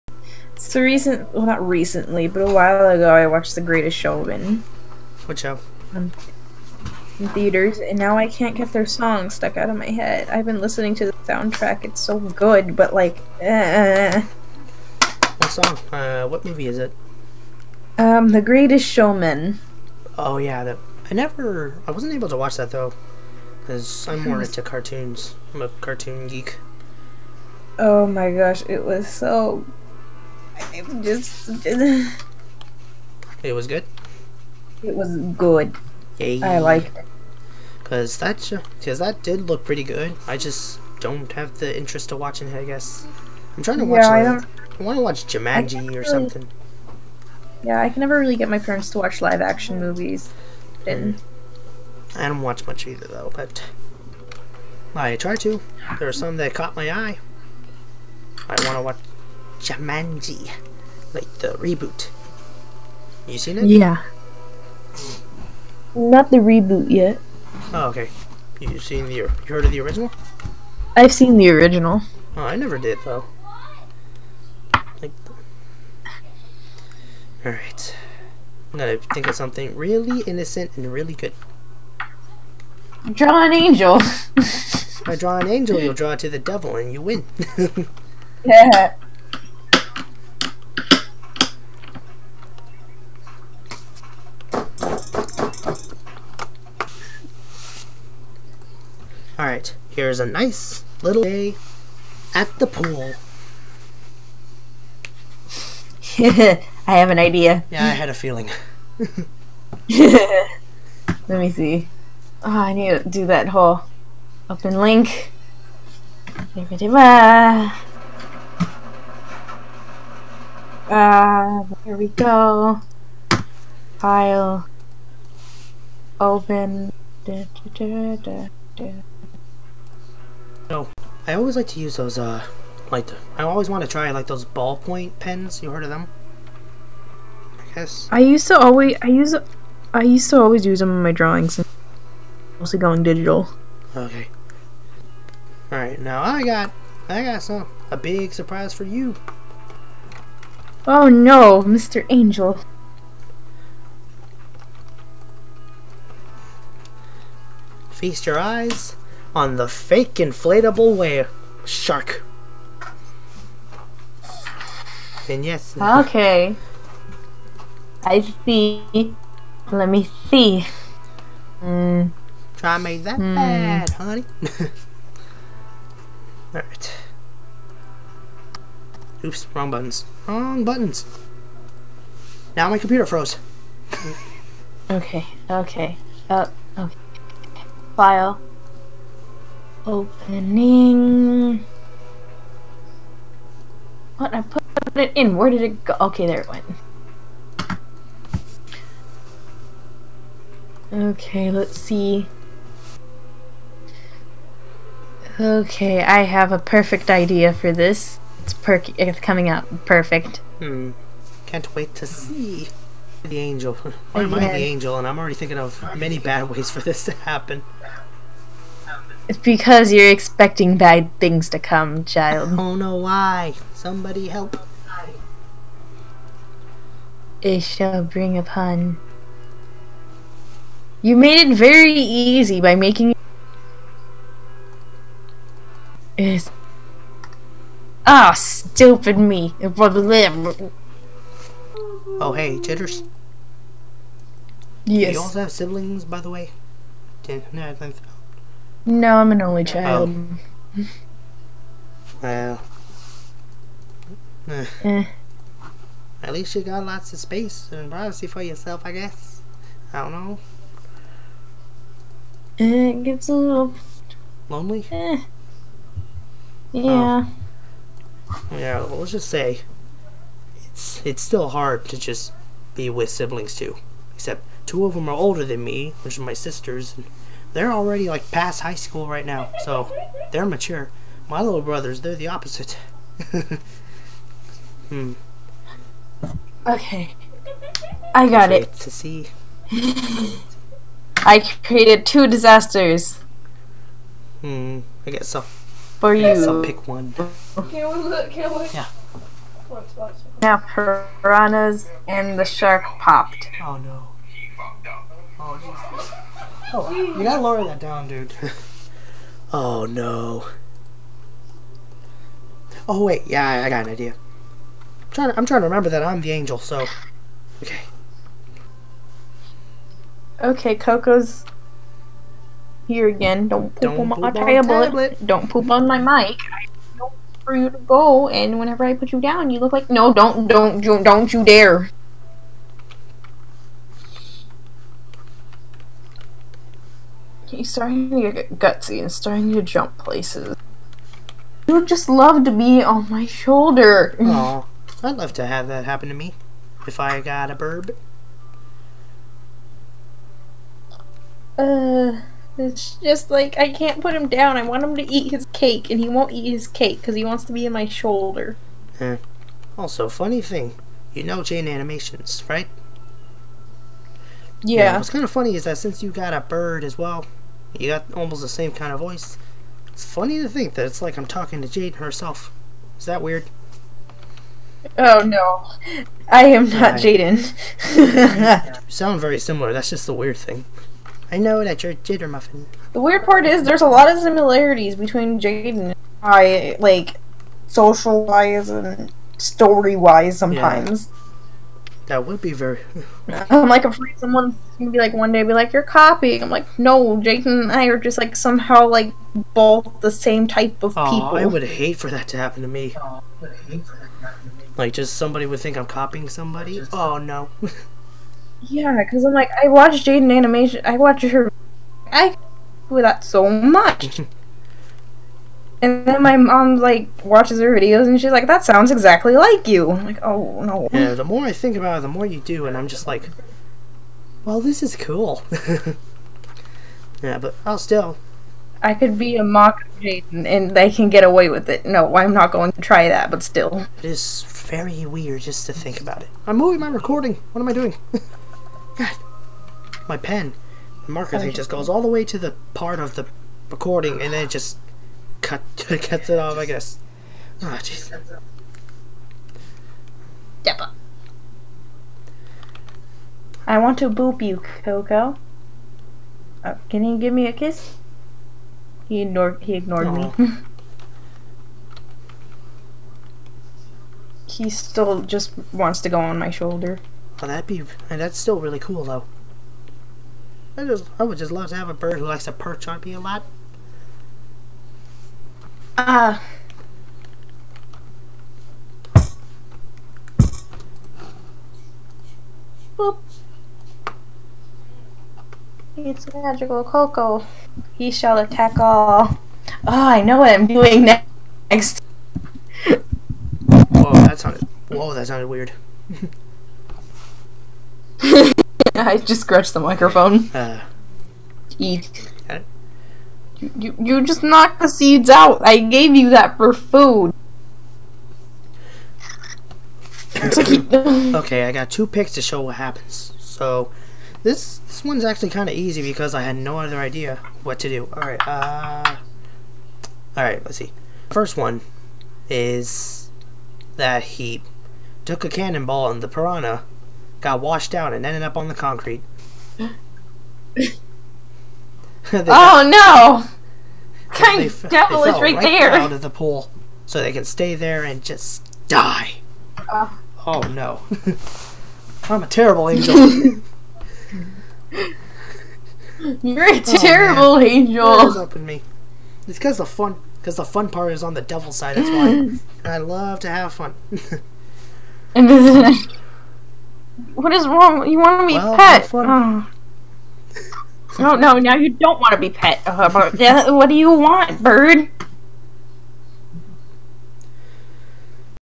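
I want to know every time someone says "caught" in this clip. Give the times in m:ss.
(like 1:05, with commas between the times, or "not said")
0:56.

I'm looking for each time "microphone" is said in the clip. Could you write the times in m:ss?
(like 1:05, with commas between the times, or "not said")
8:19.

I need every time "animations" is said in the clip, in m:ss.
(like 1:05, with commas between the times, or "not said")
6:01, 6:50.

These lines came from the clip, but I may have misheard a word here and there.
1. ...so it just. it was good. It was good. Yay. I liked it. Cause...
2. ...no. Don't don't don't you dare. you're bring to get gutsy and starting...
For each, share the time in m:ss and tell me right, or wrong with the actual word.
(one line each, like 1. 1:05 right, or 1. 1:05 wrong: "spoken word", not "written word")
1. 0:29 right
2. 5:29 wrong: "starting", not "bring".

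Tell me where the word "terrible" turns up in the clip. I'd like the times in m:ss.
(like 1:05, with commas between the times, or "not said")
9:02, 9:06.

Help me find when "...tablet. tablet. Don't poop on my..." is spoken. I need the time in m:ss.
5:24.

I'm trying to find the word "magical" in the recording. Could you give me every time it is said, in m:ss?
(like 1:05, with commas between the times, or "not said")
8:06.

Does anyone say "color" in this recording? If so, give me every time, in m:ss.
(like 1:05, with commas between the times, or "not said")
not said.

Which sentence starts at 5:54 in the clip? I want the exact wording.
I want him to eat his cake, and he won't eat his cake because he wants to be in my shoulder.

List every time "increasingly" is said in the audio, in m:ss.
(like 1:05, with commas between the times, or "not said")
not said.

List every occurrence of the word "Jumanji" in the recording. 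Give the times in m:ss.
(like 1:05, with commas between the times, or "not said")
0:45, 0:59.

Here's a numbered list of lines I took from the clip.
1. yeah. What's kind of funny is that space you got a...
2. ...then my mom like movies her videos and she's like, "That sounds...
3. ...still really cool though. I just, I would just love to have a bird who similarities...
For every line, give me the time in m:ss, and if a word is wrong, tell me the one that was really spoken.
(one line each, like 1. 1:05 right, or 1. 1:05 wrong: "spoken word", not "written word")
1. 6:04 wrong: "since", not "space"
2. 6:56 wrong: "watches", not "movies"
3. 7:48 wrong: "likes", not "similarities".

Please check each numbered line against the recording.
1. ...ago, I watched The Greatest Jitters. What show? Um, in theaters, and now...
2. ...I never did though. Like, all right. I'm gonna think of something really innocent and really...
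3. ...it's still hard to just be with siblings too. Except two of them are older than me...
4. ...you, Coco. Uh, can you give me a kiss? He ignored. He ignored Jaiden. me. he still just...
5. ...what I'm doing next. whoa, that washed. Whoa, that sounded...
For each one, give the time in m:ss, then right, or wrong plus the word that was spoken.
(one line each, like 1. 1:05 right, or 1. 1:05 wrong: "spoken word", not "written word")
1. 0:02 wrong: "Showman", not "Jitters"
2. 1:12 right
3. 4:31 right
4. 7:34 wrong: "Aww", not "Jaiden"
5. 8:10 wrong: "sounded", not "washed".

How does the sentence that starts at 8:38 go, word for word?
All right, uh, all right, let's see.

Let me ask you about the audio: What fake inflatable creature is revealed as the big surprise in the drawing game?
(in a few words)
whale shark.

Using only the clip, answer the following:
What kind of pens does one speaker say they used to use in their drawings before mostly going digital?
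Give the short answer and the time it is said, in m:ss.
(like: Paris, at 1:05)
ballpoint pens, at 2:14.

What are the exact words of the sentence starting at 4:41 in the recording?
My little brothers, they're the opposite.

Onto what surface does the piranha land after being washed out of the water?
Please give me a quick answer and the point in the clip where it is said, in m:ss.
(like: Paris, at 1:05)
concrete, at 8:48.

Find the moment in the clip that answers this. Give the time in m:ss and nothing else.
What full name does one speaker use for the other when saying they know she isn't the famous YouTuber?
6:21.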